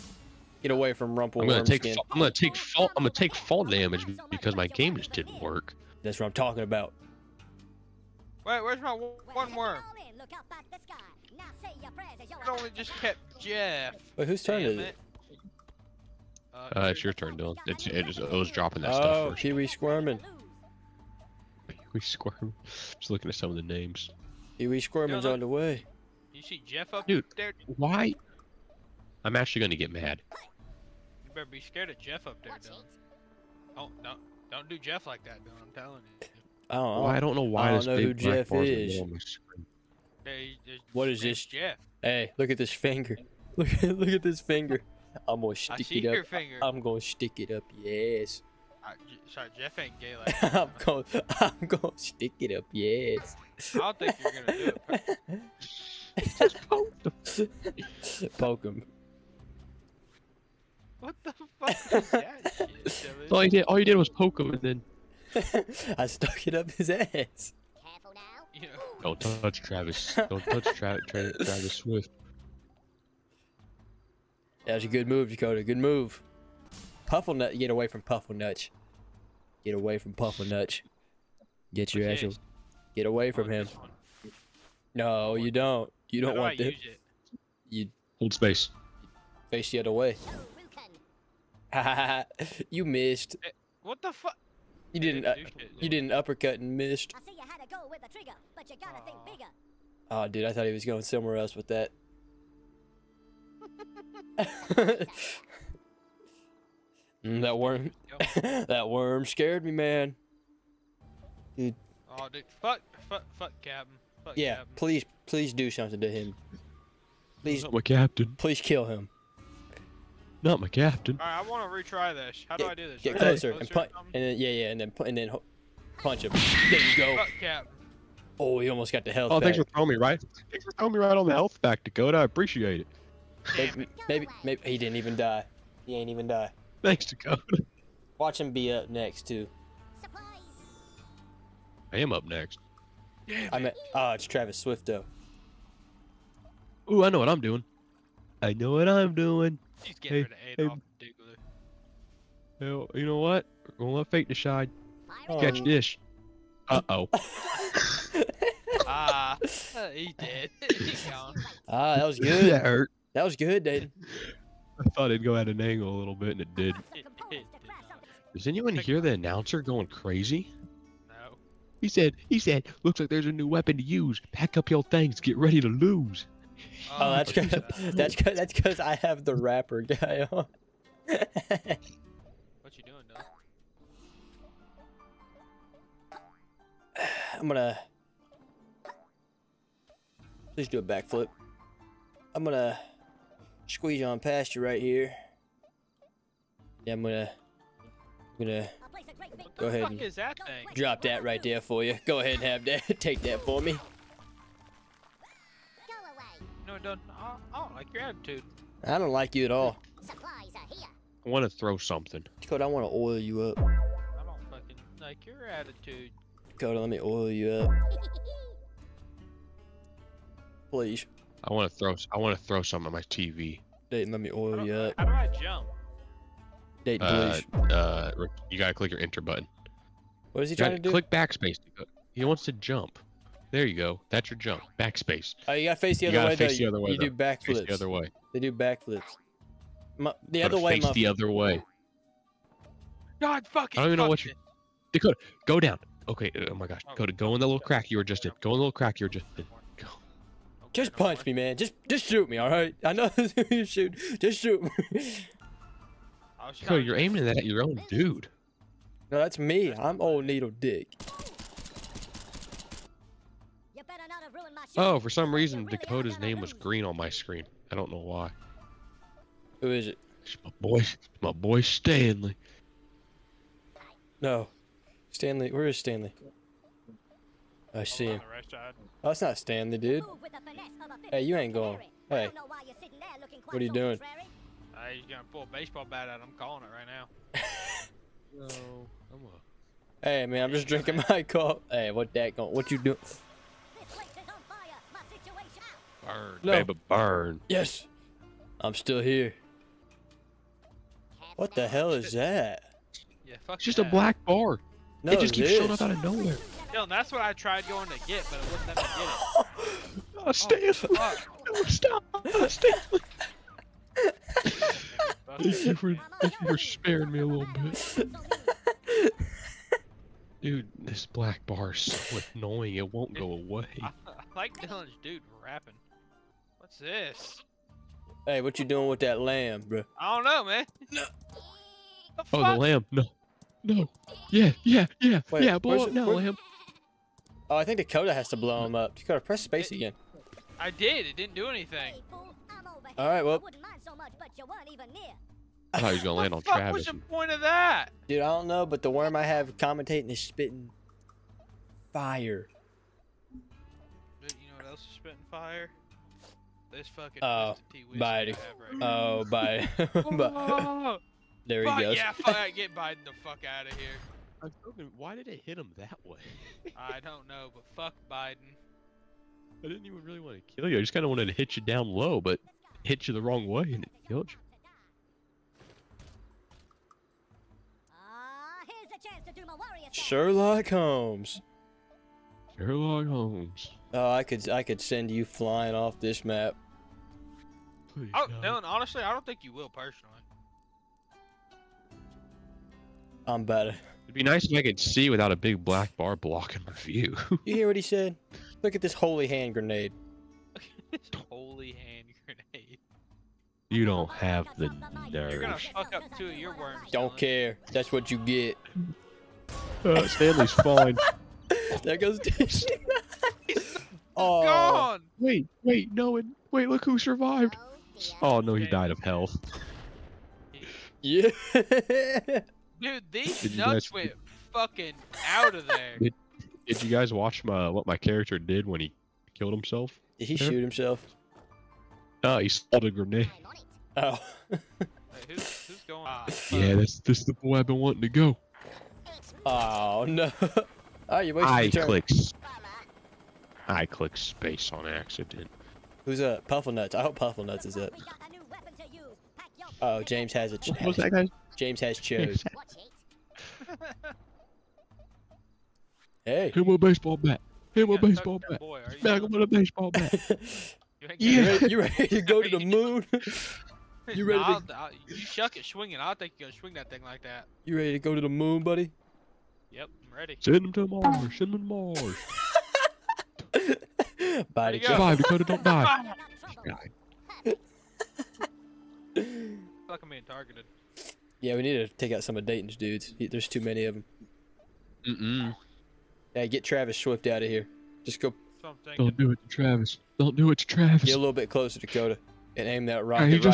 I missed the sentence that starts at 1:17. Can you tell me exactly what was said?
Puffle nut, get away from Puffle nutch.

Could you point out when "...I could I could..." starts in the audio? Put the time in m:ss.
6:24.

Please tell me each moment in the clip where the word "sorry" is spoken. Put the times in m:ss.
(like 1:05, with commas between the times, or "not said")
0:49.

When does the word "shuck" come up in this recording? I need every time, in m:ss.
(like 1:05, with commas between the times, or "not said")
7:45.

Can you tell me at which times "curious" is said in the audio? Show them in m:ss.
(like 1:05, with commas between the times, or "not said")
not said.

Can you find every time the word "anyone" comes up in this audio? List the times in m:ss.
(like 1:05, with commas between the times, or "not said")
2:48.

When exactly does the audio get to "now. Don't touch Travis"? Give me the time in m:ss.
1:08.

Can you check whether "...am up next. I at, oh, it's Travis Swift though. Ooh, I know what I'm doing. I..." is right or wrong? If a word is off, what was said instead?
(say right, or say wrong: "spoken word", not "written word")
right.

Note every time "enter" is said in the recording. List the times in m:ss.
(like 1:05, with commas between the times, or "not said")
3:49.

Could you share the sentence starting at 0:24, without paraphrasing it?
Kiwi Squirmin's Dylan, on the way.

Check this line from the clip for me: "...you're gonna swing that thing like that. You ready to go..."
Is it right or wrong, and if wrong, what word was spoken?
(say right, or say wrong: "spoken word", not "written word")
right.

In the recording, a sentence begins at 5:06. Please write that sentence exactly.
Yo, that's what I tried going to get, but it wouldn't let me get it.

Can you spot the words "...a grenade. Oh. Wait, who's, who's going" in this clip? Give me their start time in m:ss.
7:12.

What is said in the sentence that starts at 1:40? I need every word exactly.
Oh, dude, I thought he was going somewhere else with that.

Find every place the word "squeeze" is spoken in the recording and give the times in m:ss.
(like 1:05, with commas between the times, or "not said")
3:13.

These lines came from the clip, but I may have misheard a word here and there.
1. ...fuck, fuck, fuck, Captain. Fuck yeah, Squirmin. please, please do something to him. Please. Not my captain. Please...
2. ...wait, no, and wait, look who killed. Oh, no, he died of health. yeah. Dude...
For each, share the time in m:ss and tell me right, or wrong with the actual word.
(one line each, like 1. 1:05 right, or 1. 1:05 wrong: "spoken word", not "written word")
1. 1:52 wrong: "Captain", not "Squirmin"
2. 6:55 wrong: "survived", not "killed".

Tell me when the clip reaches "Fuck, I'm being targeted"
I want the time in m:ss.
7:59.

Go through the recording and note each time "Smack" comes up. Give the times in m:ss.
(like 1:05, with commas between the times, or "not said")
7:39.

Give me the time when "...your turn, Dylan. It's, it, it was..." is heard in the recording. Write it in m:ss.
0:17.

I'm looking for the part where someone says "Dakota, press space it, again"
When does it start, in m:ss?
5:38.